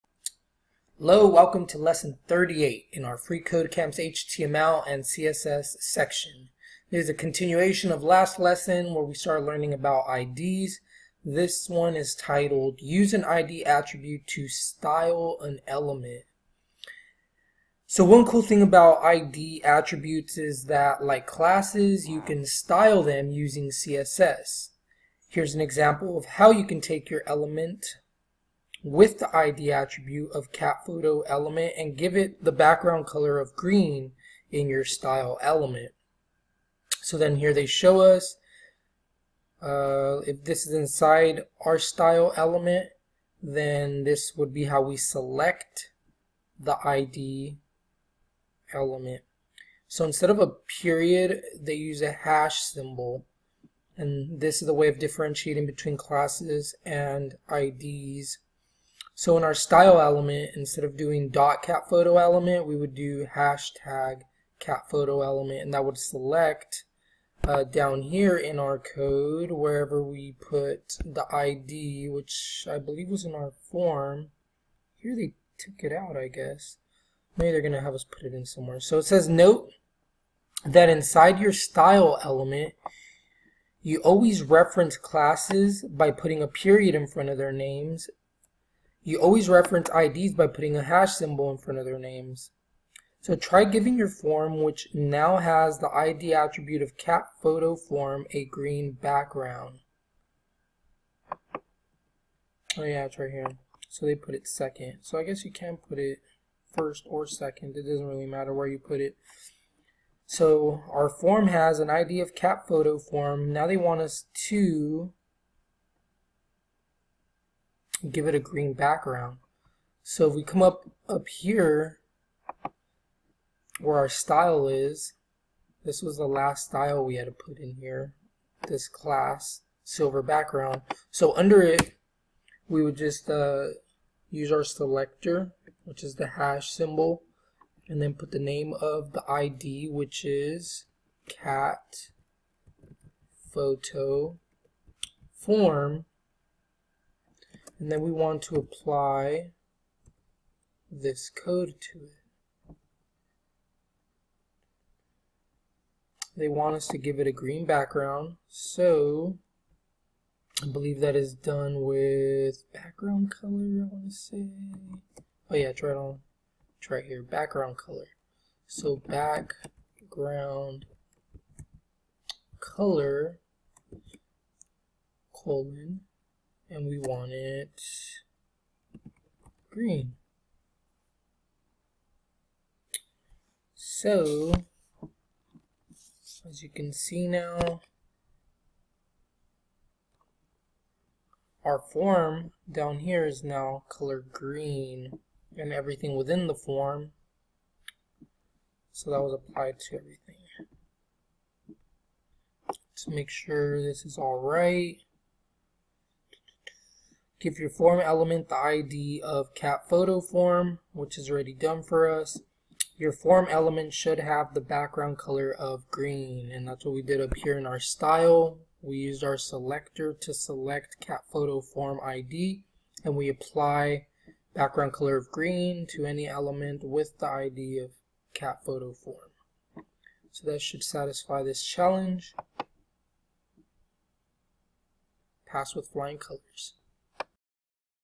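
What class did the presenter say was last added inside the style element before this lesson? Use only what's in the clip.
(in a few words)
silver background.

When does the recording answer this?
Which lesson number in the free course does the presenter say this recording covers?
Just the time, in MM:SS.
00:01.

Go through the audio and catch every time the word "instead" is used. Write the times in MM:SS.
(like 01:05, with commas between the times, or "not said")
00:50, 01:00.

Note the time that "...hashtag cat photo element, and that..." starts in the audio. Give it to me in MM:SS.
01:03.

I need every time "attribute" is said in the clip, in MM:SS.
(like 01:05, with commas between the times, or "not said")
00:13, 00:19, 00:29, 01:36.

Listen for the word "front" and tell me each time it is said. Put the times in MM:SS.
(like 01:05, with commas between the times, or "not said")
01:27, 01:31.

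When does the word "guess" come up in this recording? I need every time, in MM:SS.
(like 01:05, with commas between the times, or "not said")
01:16, 01:45.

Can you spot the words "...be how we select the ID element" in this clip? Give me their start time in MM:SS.
00:44.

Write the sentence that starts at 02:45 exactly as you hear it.
Oh yeah, try it on, Try right here, background color.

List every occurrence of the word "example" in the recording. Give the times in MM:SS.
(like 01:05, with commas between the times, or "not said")
00:25.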